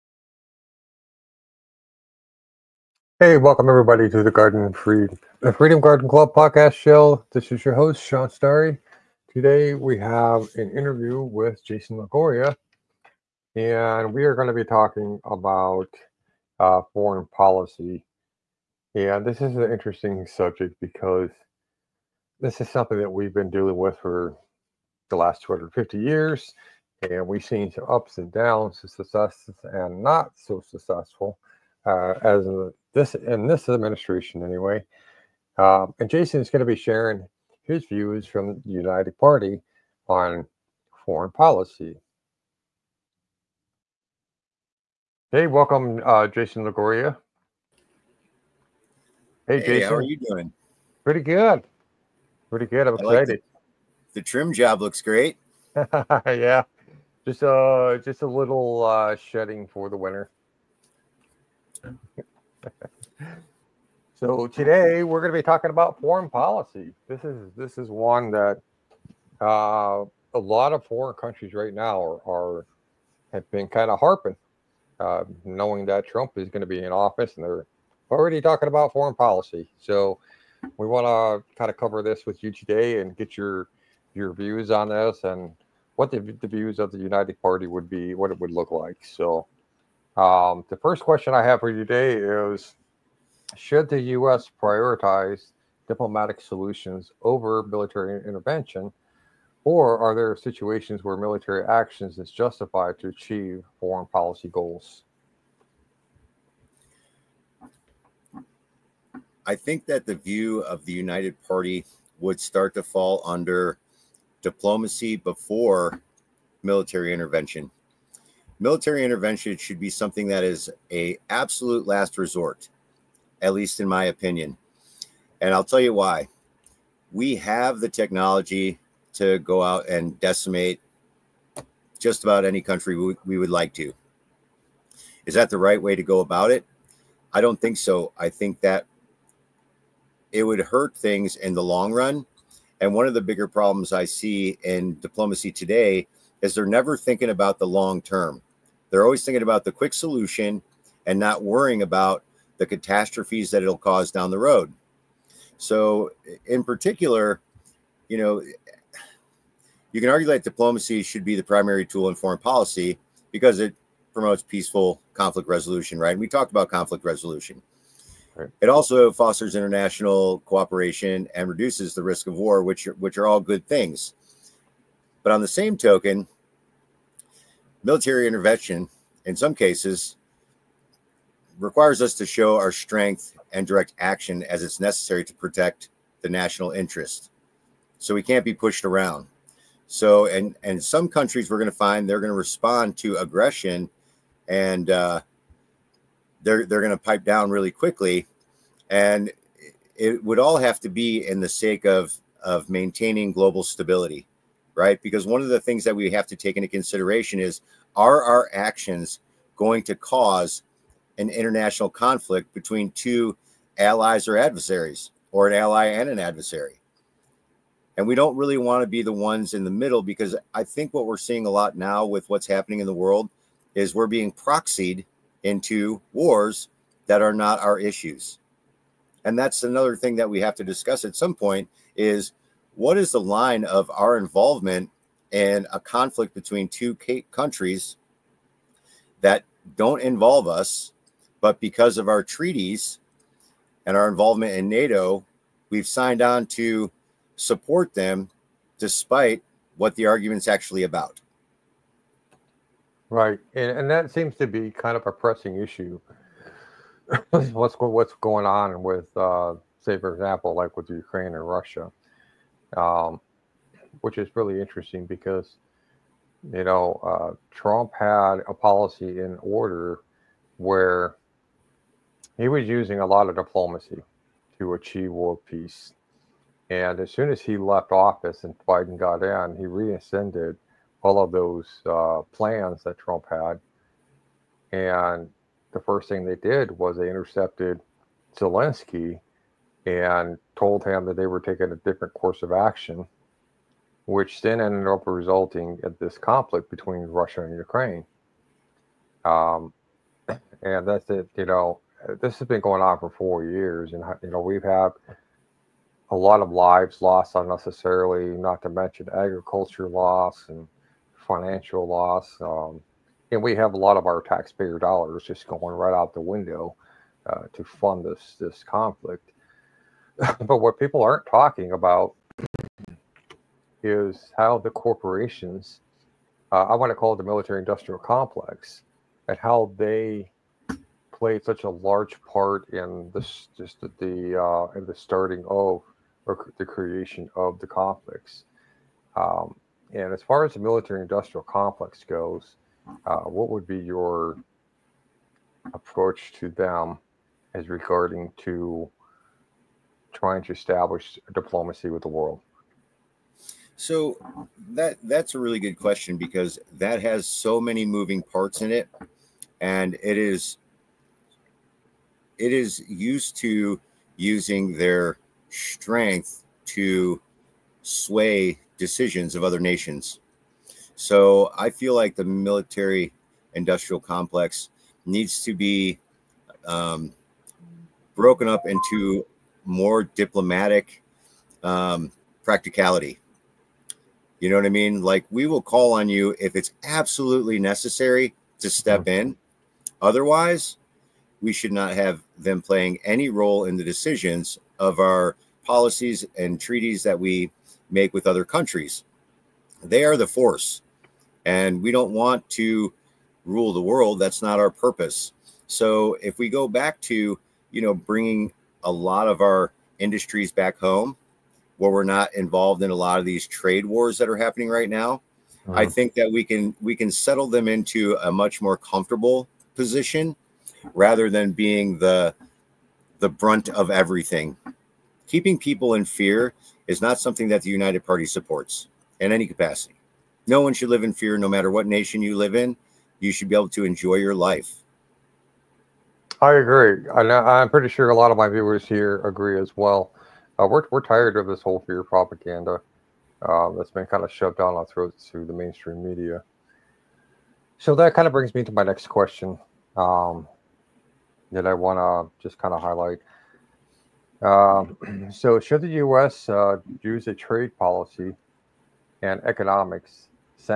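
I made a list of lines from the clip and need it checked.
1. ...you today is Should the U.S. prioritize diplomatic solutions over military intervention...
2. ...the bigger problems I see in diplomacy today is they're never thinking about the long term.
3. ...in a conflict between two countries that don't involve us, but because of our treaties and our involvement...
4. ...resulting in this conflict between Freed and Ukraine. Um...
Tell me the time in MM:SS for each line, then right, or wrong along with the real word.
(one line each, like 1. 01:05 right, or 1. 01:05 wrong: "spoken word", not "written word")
1. 01:31 right
2. 02:23 right
3. 03:55 right
4. 04:55 wrong: "Russia", not "Freed".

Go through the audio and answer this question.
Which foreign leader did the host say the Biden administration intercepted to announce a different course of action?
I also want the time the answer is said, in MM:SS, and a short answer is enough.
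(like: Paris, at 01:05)
Zelensky, at 04:48.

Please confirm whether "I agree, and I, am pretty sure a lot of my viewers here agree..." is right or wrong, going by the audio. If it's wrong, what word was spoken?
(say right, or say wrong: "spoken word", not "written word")
right.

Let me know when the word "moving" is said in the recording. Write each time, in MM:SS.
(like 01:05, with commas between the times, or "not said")
05:57.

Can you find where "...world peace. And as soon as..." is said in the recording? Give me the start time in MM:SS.
04:35.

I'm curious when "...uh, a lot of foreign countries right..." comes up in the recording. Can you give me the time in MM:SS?
01:09.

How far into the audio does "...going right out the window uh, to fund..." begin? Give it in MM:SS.
05:15.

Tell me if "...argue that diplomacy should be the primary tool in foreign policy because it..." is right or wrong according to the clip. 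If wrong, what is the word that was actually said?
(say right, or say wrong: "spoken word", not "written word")
right.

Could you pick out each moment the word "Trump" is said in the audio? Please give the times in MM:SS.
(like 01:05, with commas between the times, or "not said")
01:16, 04:27, 04:42.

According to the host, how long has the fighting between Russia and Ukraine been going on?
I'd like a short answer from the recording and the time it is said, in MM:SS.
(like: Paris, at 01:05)
4 years, at 05:03.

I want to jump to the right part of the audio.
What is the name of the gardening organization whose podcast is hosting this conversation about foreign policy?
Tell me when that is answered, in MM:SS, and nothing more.
00:05.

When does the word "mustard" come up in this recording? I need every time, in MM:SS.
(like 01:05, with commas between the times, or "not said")
not said.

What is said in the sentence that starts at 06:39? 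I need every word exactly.
They are the force, and we don't want to rule the world.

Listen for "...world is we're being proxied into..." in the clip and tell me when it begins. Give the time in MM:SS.
03:42.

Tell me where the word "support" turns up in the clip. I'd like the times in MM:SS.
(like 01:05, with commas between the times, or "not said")
04:07, 07:08.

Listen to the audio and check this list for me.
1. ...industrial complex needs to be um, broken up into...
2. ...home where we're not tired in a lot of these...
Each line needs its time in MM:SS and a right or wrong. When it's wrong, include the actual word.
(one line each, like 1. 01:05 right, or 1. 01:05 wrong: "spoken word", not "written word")
1. 06:13 right
2. 06:50 wrong: "involved", not "tired".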